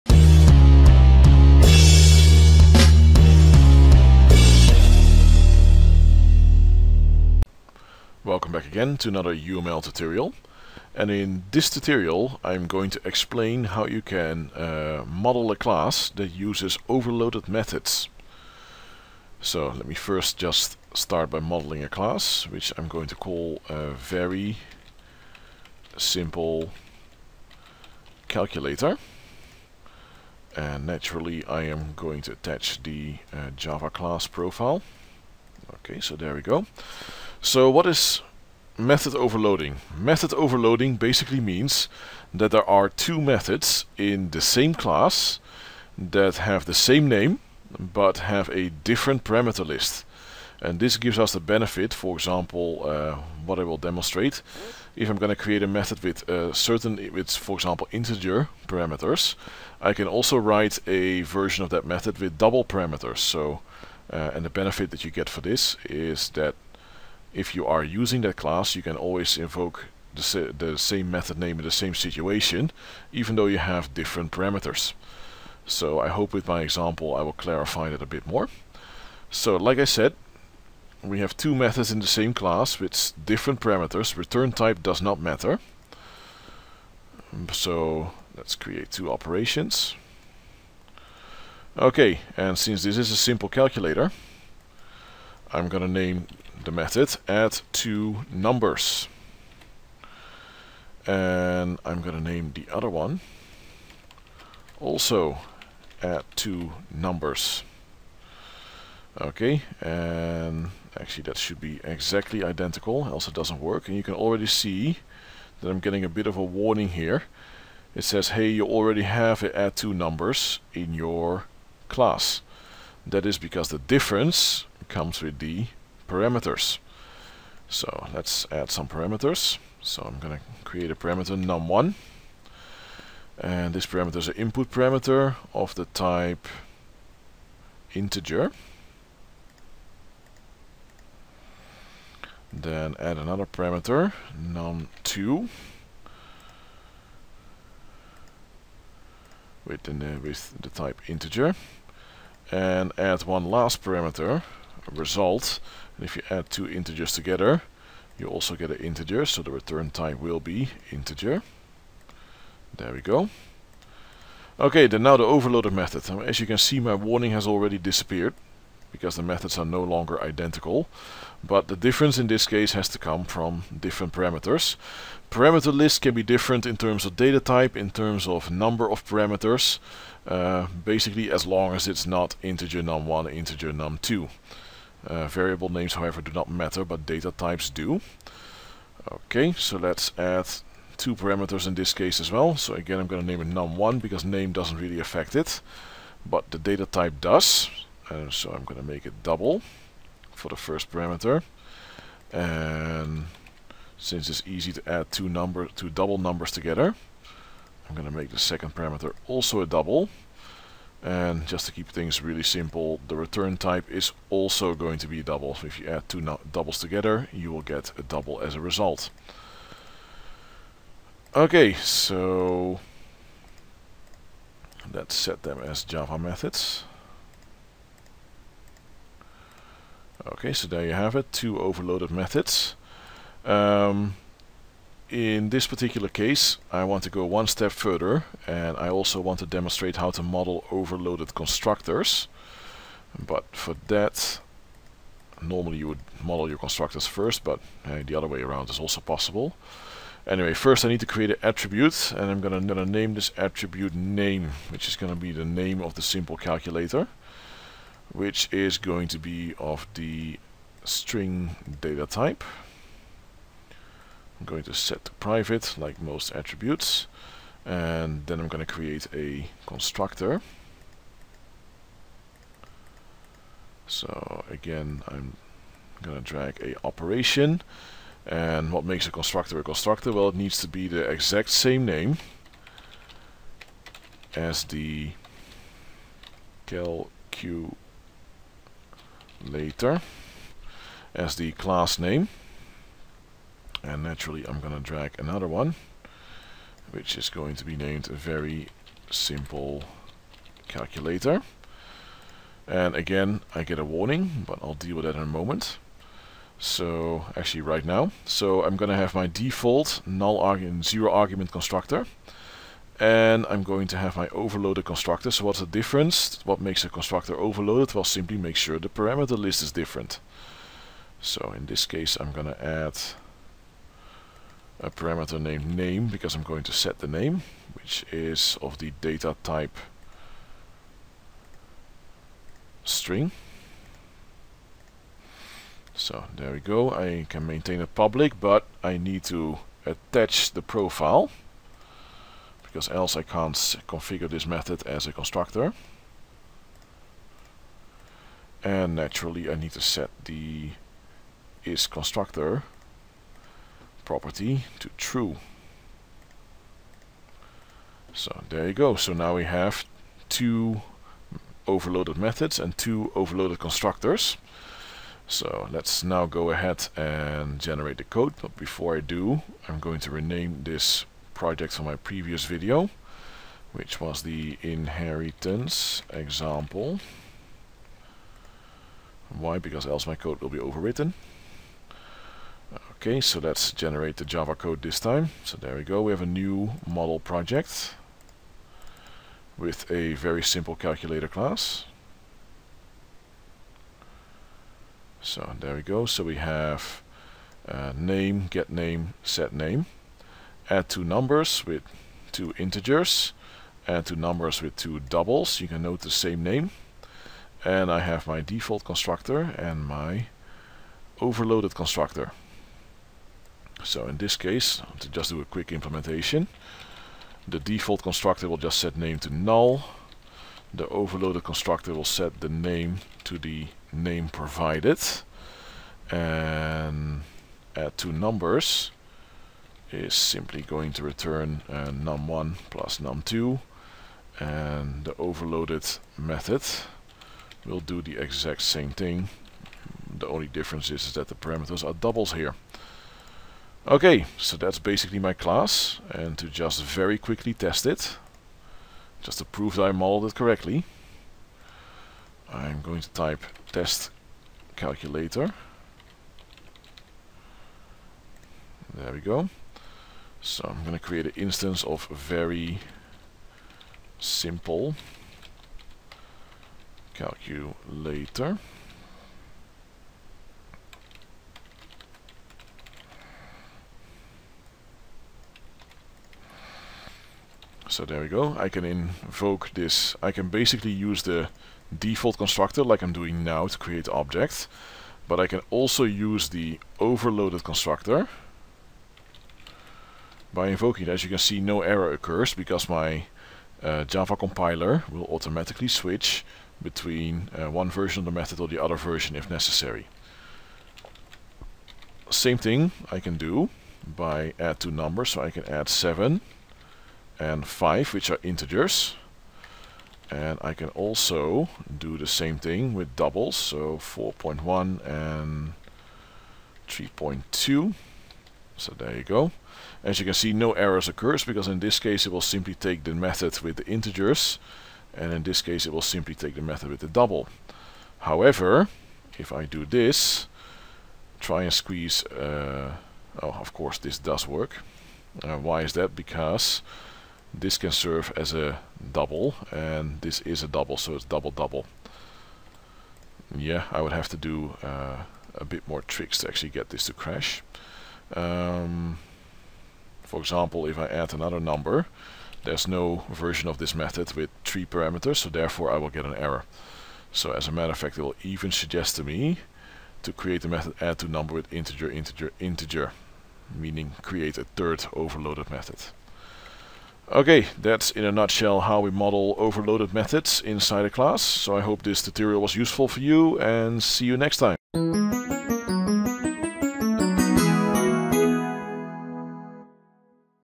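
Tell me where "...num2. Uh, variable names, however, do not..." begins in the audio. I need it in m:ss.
3:03.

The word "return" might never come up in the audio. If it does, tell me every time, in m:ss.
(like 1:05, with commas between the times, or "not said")
1:24, 2:39, 3:33, 7:11.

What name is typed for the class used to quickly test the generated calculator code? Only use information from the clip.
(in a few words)
test calculator.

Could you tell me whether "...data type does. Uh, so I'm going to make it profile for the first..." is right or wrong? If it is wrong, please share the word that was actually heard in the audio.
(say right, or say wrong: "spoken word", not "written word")
wrong: "double", not "profile".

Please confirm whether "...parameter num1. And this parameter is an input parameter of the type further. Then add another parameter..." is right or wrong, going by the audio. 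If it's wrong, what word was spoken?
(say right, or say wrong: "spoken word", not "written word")
wrong: "integer", not "further".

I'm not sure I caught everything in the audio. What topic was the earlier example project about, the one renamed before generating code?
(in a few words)
inheritance.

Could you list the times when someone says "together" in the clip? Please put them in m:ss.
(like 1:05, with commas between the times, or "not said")
2:37, 3:26, 3:36.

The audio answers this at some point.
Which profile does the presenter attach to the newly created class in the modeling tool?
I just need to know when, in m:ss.
0:33.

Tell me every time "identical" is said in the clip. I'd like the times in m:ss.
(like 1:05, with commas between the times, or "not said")
1:52, 2:50.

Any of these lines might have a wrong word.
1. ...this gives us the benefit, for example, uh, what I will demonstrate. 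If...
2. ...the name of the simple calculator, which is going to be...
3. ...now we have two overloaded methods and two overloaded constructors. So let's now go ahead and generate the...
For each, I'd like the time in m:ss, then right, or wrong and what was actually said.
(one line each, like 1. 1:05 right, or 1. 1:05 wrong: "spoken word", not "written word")
1. 0:50 right
2. 4:15 right
3. 5:59 right.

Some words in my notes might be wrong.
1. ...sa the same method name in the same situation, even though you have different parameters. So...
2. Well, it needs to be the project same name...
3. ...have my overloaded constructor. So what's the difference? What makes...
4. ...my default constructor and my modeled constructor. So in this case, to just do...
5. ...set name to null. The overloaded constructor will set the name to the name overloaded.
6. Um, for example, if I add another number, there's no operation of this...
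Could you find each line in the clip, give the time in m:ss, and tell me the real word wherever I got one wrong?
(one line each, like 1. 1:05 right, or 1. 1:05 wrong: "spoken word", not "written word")
1. 1:10 right
2. 4:40 wrong: "exact", not "project"
3. 5:13 right
4. 6:48 wrong: "overloaded", not "modeled"
5. 6:58 wrong: "provided", not "overloaded"
6. 9:08 wrong: "version", not "operation".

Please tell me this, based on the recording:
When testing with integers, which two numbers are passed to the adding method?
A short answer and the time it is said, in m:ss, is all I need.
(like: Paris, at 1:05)
7 and 5, at 8:25.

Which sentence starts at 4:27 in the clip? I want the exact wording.
And then I'm going to create a constructor.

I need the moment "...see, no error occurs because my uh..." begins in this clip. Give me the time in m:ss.
8:11.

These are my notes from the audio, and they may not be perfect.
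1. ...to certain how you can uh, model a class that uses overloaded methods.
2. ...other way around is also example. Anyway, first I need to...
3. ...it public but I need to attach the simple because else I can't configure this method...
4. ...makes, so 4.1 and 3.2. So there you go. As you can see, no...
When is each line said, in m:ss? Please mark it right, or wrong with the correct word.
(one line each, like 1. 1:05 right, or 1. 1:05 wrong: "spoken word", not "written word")
1. 0:12 wrong: "explain", not "certain"
2. 4:08 wrong: "possible", not "example"
3. 5:37 wrong: "profile", not "simple"
4. 8:33 wrong: "doubles", not "makes".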